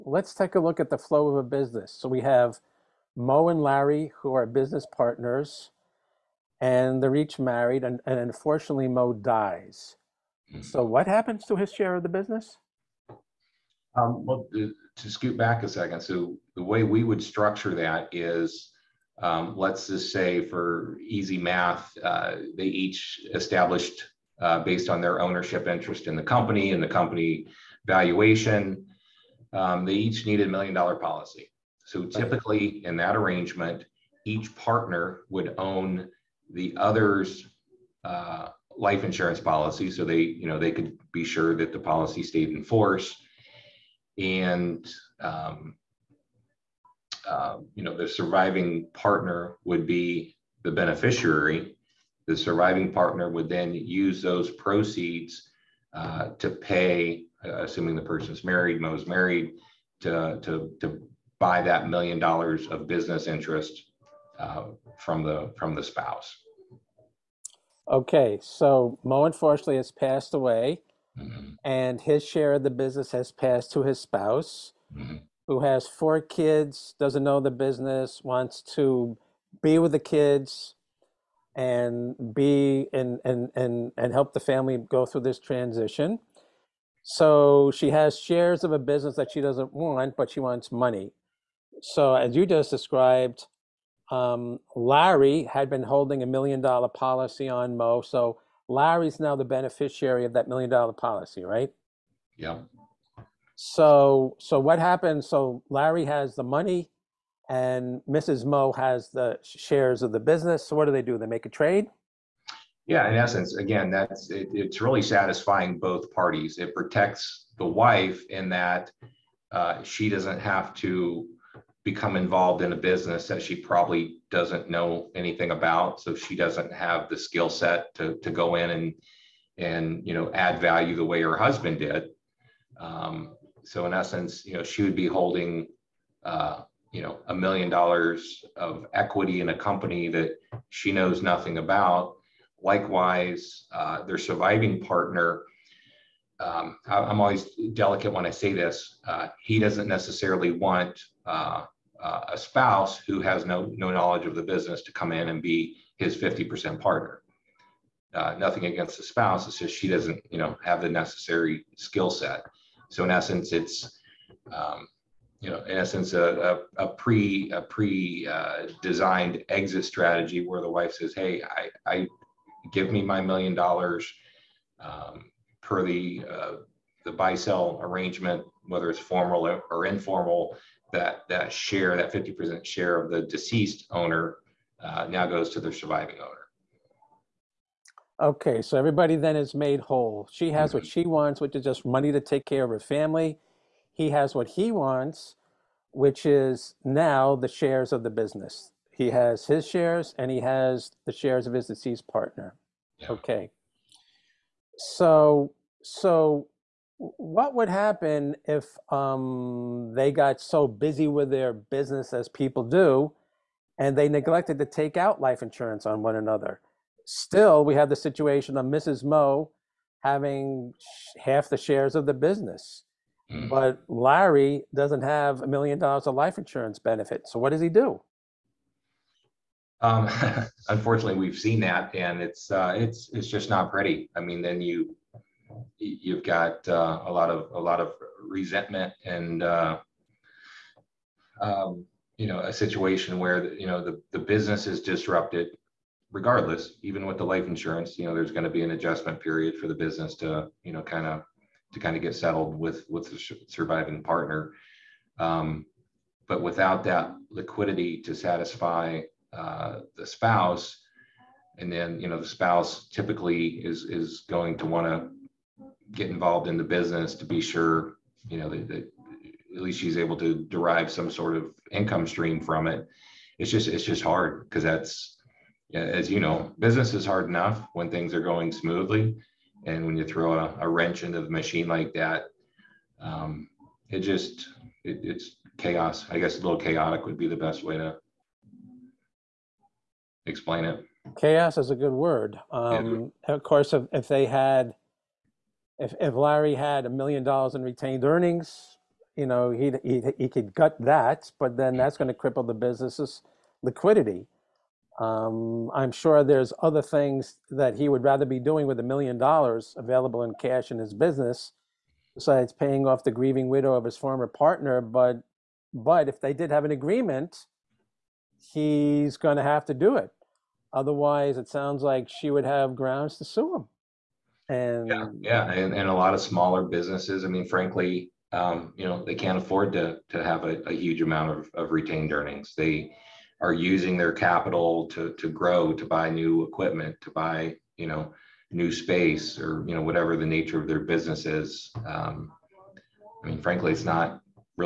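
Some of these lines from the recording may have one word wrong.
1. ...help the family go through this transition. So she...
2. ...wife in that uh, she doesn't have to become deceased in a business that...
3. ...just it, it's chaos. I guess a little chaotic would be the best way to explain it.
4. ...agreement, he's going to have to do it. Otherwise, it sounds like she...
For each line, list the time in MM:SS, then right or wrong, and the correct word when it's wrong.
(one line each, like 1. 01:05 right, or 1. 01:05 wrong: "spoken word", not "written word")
1. 01:24 right
2. 01:57 wrong: "involved", not "deceased"
3. 04:43 right
4. 05:16 right.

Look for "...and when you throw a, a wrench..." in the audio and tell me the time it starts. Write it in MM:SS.
04:39.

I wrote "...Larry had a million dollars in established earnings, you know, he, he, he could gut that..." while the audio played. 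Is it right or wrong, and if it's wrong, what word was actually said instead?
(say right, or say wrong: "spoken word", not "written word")
wrong: "retained", not "established".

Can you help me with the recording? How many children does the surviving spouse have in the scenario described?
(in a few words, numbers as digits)
4.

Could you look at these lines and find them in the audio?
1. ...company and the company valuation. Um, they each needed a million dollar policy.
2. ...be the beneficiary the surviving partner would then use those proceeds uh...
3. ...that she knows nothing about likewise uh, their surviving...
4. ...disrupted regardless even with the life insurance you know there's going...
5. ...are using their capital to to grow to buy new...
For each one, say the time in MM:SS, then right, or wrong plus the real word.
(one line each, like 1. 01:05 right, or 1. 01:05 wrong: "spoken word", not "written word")
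1. 00:26 right
2. 00:49 right
3. 02:20 right
4. 04:04 right
5. 05:33 right.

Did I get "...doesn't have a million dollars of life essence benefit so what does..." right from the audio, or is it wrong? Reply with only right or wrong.
wrong.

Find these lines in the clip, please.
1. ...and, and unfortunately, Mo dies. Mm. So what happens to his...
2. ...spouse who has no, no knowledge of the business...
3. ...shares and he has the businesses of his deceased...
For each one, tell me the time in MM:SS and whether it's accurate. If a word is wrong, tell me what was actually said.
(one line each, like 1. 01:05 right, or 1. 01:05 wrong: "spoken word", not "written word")
1. 00:07 right
2. 02:32 right
3. 03:19 wrong: "shares", not "businesses".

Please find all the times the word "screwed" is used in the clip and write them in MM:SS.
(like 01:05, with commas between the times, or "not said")
not said.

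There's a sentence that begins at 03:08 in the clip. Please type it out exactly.
Okay, so everybody then is made whole.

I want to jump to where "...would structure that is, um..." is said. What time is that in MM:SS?
00:17.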